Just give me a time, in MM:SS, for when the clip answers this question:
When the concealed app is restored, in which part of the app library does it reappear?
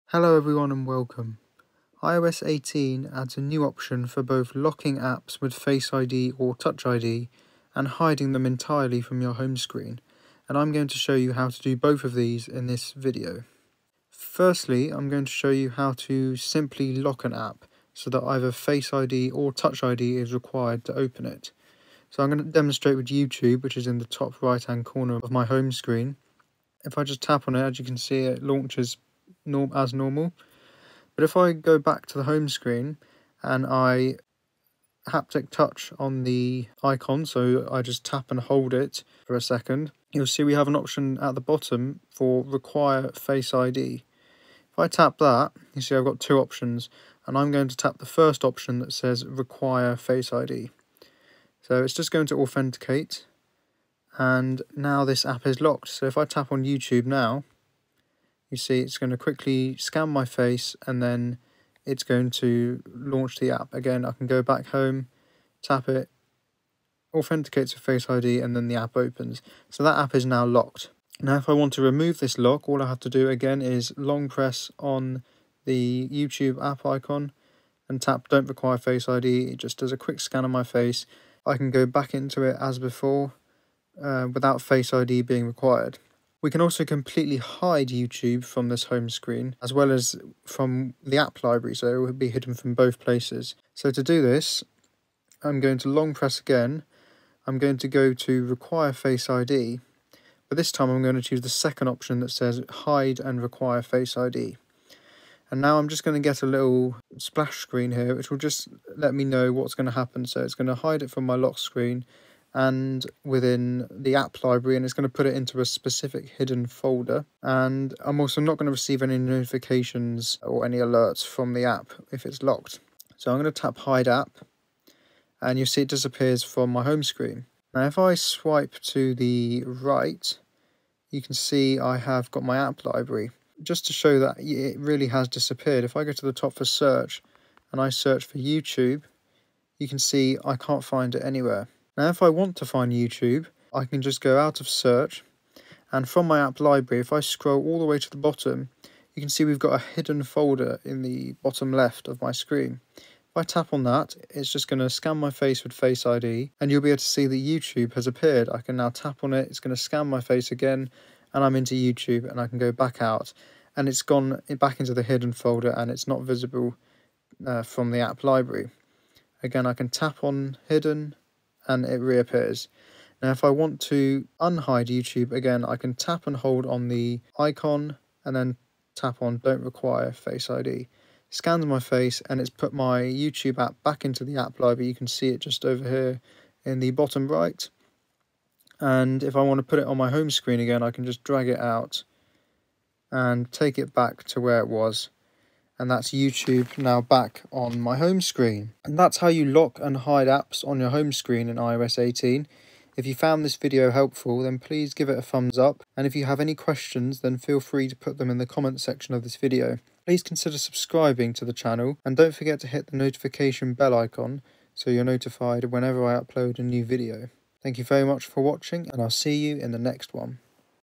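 03:06.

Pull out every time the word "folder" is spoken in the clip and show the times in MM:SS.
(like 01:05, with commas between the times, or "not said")
01:56, 02:30, 02:45.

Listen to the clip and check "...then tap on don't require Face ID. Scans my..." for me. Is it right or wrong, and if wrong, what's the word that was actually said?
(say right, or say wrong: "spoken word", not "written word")
right.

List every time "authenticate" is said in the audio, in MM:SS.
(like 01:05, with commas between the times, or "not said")
00:52, 01:07.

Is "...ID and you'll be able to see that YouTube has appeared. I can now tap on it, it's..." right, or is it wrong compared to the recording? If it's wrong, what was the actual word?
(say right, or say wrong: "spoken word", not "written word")
right.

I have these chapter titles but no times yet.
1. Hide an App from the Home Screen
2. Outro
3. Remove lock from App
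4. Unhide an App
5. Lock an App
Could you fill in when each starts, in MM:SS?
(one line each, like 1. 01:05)
1. 01:26
2. 03:19
3. 01:13
4. 02:53
5. 00:13.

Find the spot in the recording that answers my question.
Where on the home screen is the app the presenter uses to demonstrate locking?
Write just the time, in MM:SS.
00:24.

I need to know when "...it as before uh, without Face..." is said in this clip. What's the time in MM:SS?
01:22.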